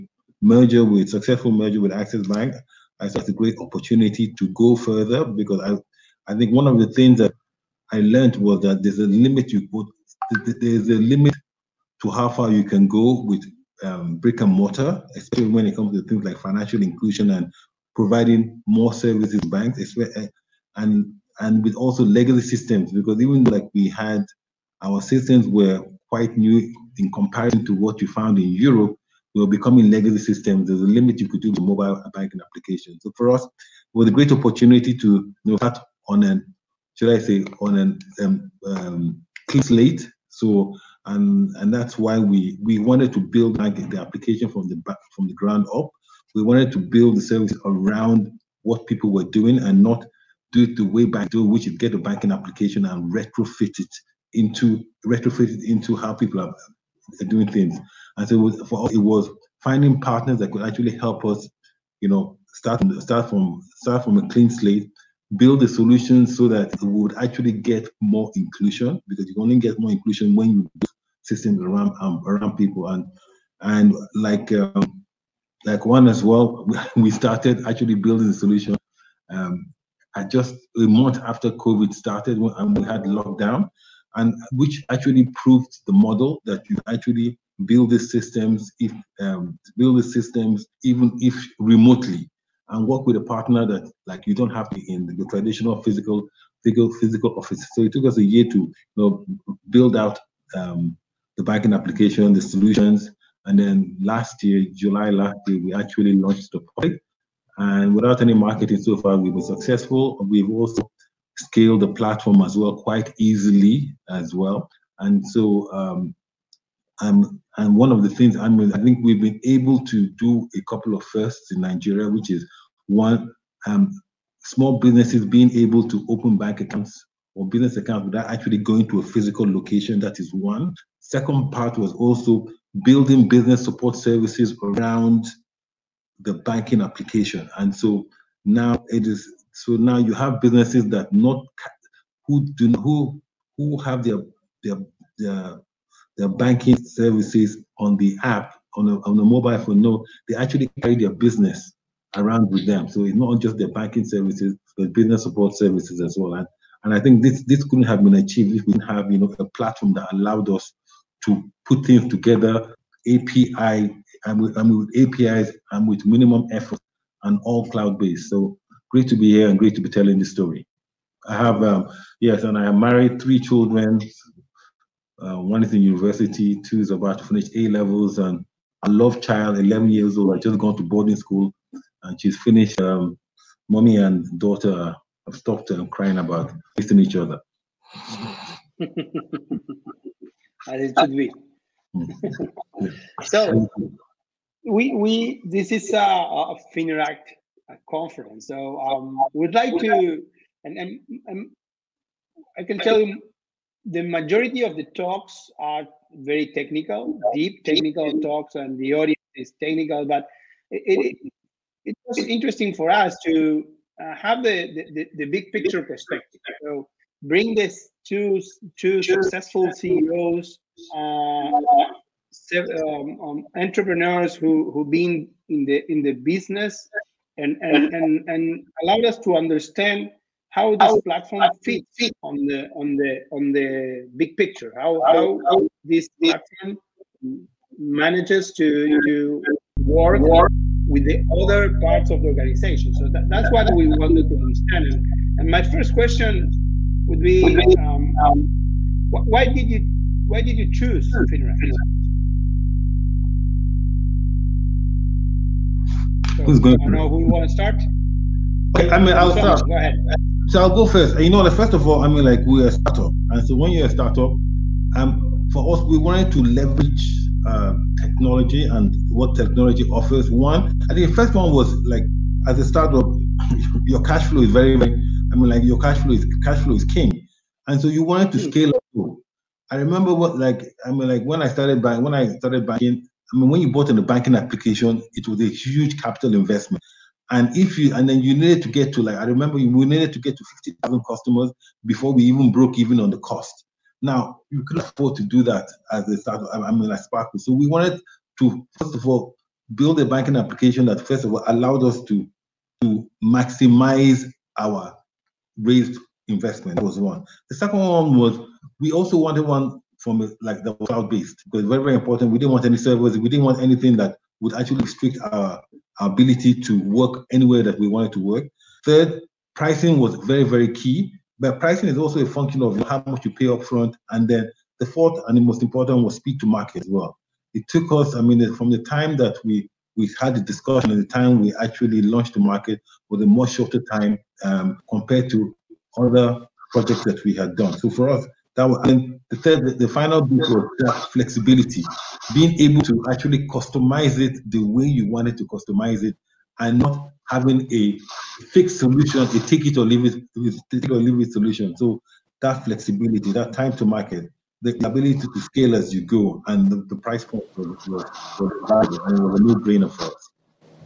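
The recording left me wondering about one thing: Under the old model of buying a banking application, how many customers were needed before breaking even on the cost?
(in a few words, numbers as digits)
50,000.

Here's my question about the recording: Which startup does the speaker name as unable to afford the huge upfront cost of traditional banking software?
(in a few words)
Sparkle.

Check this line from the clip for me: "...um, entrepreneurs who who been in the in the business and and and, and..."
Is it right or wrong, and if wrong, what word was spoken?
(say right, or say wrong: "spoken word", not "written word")
right.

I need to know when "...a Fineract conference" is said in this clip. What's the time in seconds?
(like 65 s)
196 s.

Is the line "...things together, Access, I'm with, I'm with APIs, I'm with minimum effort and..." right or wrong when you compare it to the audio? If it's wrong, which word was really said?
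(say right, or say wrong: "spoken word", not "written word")
wrong: "API", not "Access".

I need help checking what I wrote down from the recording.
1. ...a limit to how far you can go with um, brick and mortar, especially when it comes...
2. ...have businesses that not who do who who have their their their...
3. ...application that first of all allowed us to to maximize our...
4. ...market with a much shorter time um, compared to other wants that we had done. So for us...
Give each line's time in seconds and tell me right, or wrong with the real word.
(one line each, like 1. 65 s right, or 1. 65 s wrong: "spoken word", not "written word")
1. 10 s right
2. 140 s right
3. 300 s right
4. 332 s wrong: "projects", not "wants".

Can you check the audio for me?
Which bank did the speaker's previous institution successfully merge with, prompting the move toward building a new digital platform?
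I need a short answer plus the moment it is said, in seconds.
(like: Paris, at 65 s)
Access Bank, at 1 s.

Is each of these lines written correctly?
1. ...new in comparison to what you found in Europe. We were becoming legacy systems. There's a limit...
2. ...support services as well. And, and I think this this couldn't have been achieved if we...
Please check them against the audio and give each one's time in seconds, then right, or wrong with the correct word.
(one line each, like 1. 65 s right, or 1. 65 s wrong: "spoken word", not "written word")
1. 26 s right
2. 155 s right.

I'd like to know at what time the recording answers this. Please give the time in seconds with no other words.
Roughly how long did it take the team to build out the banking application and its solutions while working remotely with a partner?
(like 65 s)
98 s.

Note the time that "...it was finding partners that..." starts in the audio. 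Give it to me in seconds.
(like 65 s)
58 s.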